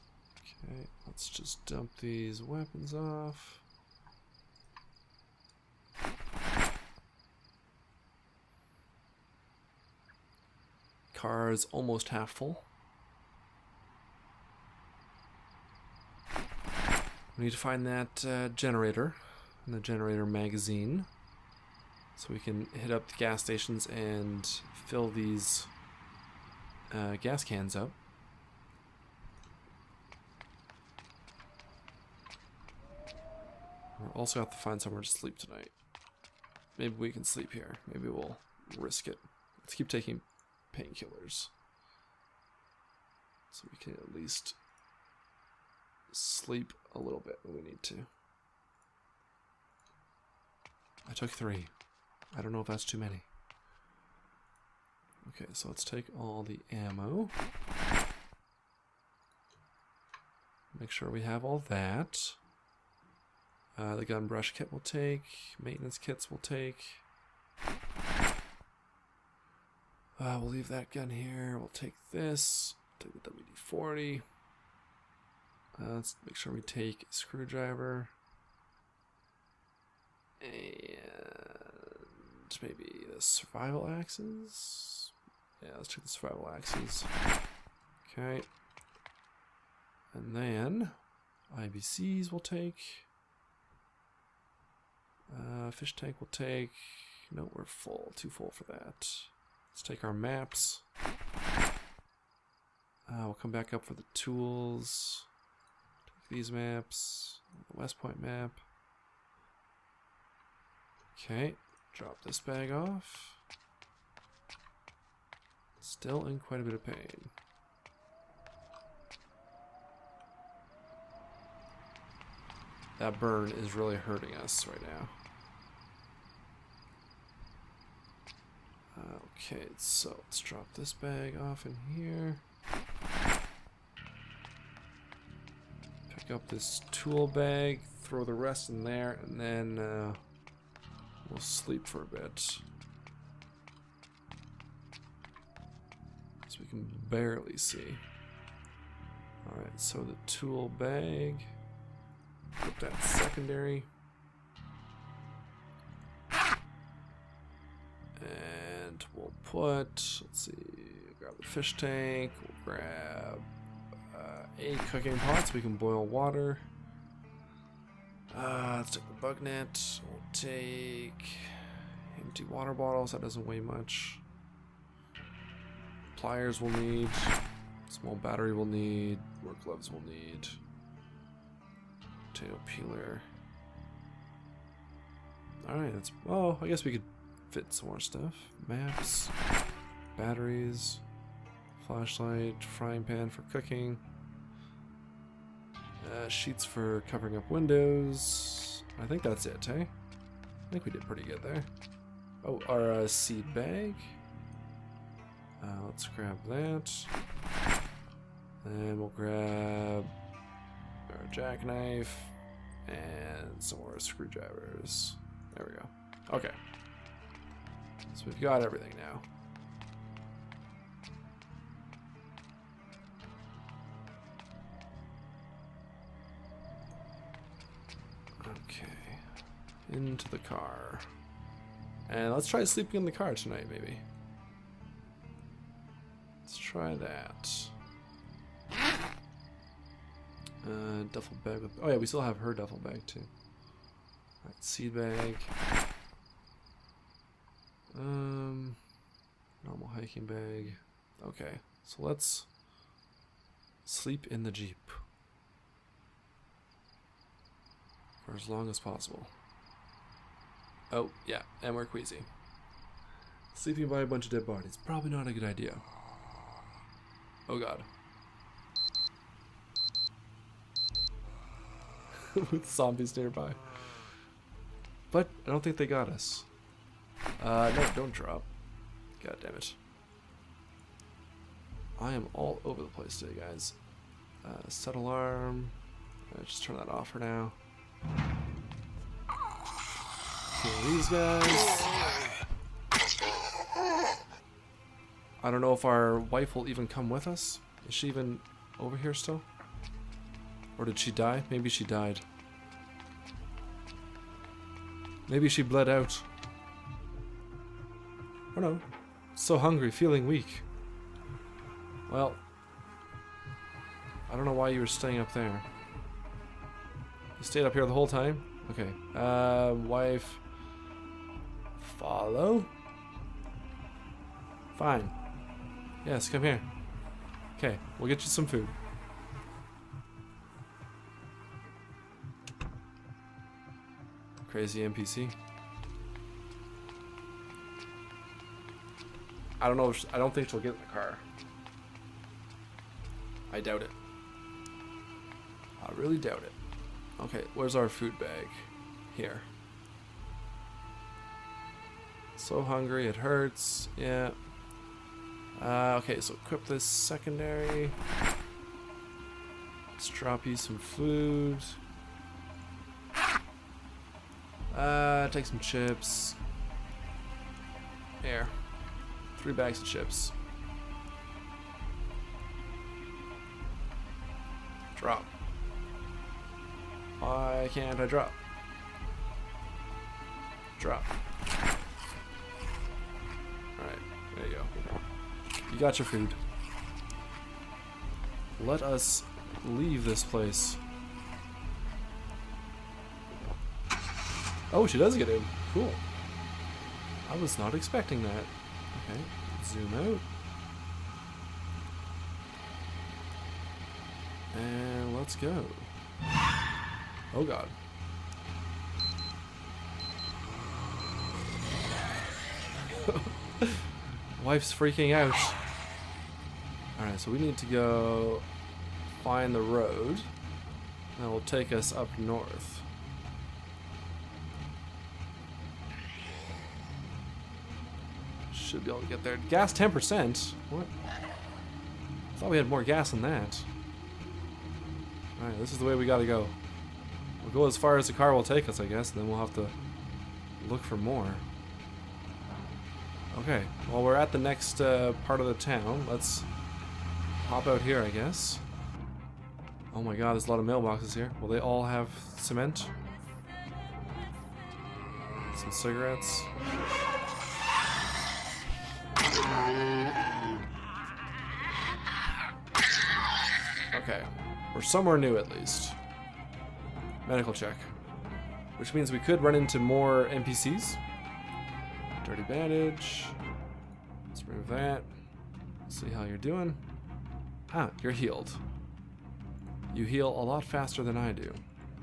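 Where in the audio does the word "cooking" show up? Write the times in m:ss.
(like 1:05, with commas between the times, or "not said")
2:44, 3:13.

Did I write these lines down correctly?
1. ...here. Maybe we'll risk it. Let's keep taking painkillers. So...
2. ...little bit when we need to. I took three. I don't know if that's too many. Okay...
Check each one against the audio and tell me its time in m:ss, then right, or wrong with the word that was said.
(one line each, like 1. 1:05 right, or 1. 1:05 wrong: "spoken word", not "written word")
1. 0:37 right
2. 0:46 right.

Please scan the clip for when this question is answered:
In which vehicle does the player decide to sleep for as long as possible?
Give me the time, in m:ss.
4:14.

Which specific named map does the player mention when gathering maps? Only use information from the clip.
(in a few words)
West Point map.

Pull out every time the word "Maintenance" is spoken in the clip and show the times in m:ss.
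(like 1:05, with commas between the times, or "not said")
1:05.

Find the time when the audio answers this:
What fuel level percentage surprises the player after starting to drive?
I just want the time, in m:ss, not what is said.
7:09.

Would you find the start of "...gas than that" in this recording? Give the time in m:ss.
7:12.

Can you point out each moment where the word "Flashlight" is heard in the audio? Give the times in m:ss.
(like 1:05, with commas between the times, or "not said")
3:11.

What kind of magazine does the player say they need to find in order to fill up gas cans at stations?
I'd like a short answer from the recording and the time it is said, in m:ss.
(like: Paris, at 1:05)
Generator magazine, at 0:19.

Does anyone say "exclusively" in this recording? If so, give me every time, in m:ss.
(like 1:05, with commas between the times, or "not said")
not said.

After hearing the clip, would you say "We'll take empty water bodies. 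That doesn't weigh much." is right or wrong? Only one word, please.
wrong.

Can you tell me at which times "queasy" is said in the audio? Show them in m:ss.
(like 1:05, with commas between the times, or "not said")
4:21.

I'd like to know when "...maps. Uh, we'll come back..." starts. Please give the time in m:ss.
1:40.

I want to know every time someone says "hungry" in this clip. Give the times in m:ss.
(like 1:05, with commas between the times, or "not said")
5:09, 5:52.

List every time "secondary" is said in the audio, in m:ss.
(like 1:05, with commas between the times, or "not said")
2:33, 5:56.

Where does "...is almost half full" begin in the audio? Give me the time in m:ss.
0:11.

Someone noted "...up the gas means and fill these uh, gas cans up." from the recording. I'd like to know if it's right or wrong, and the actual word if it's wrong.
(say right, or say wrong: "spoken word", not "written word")
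wrong: "stations", not "means".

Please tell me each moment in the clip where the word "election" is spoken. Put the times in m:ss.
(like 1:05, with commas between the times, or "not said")
not said.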